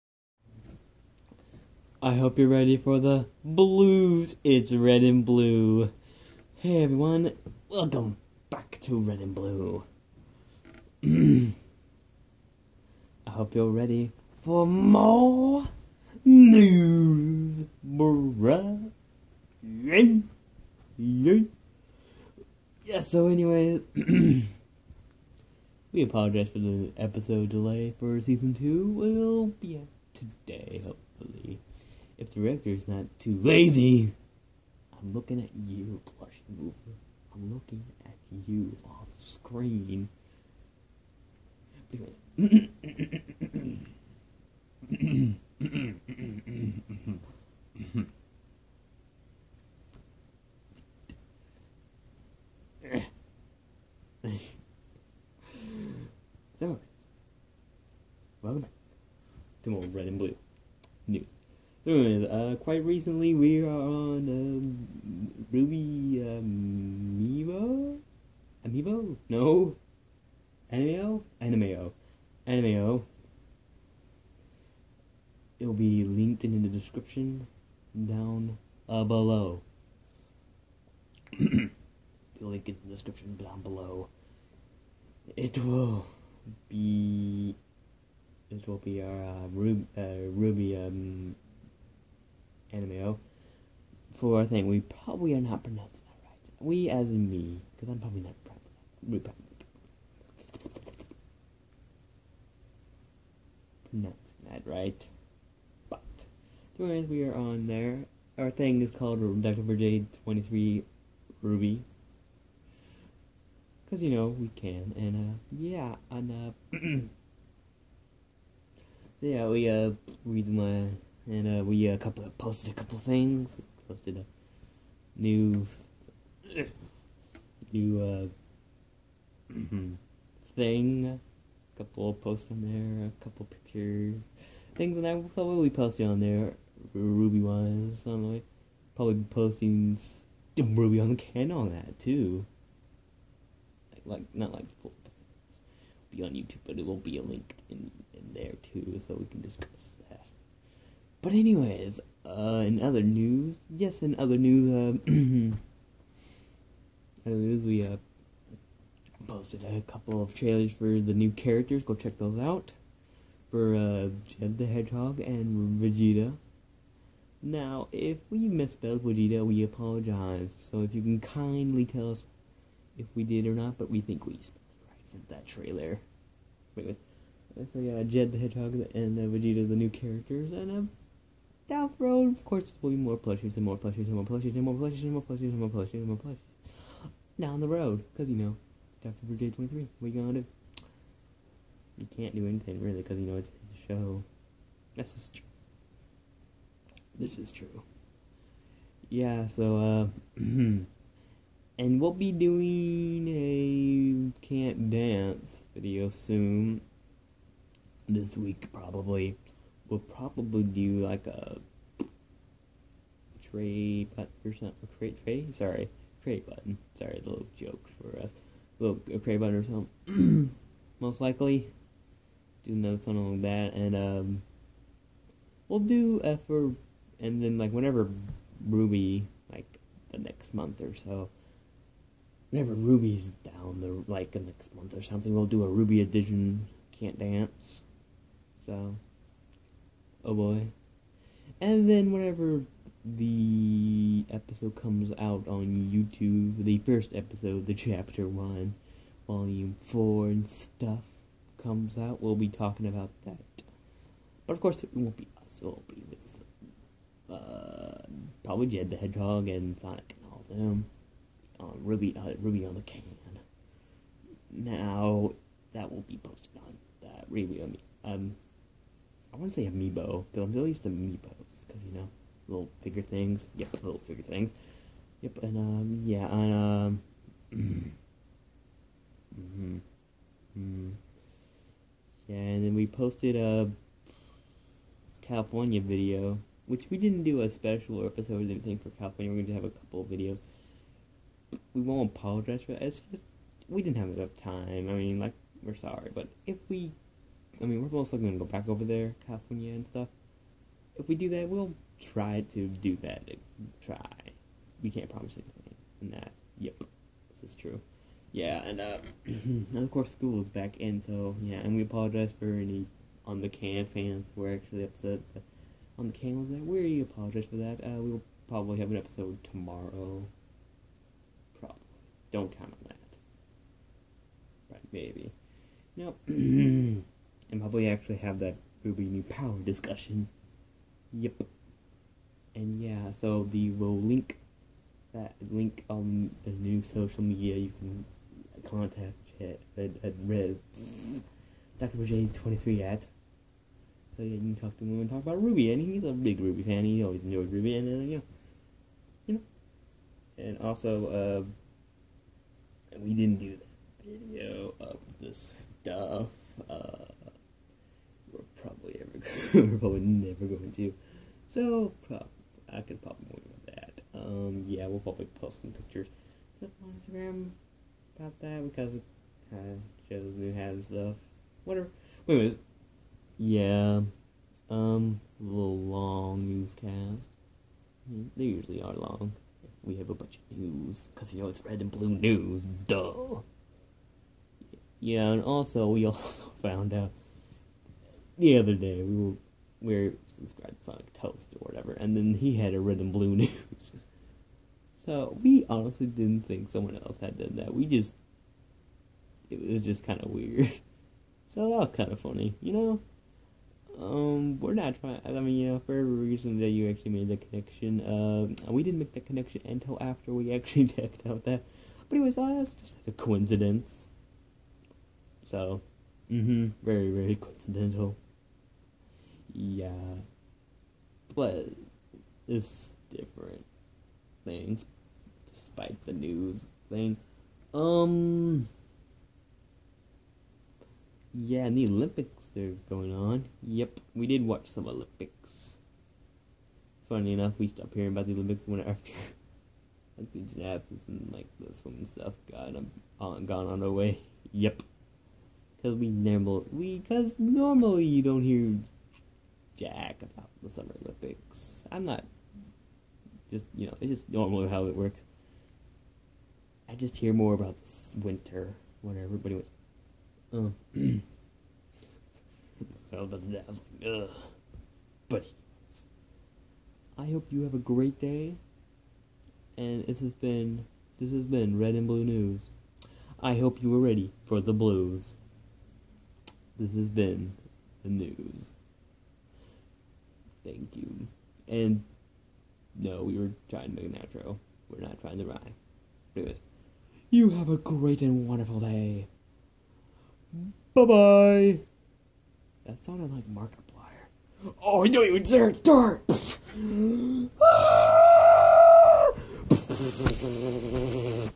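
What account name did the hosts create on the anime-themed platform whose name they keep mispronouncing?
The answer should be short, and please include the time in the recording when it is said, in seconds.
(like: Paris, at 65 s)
Dr. Brigade 23 Ruby, at 109 s.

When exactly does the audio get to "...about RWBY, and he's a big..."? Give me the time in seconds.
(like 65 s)
345 s.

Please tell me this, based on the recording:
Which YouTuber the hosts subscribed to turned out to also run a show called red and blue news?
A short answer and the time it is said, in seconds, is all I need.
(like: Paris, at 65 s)
Sonic Toast, at 390 s.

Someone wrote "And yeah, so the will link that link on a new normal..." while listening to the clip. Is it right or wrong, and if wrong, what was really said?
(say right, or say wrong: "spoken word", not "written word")
wrong: "social", not "normal".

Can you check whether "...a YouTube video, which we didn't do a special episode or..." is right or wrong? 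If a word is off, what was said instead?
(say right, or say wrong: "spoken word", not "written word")
wrong: "California", not "YouTube".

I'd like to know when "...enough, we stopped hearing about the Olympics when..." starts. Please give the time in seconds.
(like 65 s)
437 s.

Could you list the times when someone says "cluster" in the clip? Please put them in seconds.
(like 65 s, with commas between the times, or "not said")
not said.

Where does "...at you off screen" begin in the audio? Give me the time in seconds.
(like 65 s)
38 s.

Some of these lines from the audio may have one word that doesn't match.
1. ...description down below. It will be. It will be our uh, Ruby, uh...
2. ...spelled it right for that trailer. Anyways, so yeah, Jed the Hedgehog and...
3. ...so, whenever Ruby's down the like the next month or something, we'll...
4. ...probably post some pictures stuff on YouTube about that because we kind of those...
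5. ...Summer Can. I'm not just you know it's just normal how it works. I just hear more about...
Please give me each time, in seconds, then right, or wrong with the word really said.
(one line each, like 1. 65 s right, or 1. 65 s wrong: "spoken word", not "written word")
1. 82 s right
2. 174 s right
3. 230 s right
4. 364 s wrong: "Instagram", not "YouTube"
5. 450 s wrong: "Olympics", not "Can".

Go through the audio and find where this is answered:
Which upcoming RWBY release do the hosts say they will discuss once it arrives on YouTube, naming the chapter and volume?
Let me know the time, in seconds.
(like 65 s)
247 s.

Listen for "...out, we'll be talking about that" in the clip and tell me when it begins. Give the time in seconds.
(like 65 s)
251 s.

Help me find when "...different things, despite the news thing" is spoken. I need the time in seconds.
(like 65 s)
423 s.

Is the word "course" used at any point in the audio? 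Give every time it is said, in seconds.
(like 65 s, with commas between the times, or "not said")
182 s, 254 s, 309 s.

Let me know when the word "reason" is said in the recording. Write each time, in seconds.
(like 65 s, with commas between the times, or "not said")
120 s, 406 s.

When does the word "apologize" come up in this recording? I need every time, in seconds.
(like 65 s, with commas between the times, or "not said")
26 s, 169 s, 292 s, 311 s, 317 s.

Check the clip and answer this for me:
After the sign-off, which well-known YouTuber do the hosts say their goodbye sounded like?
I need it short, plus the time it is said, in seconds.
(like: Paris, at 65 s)
Markiplier, at 493 s.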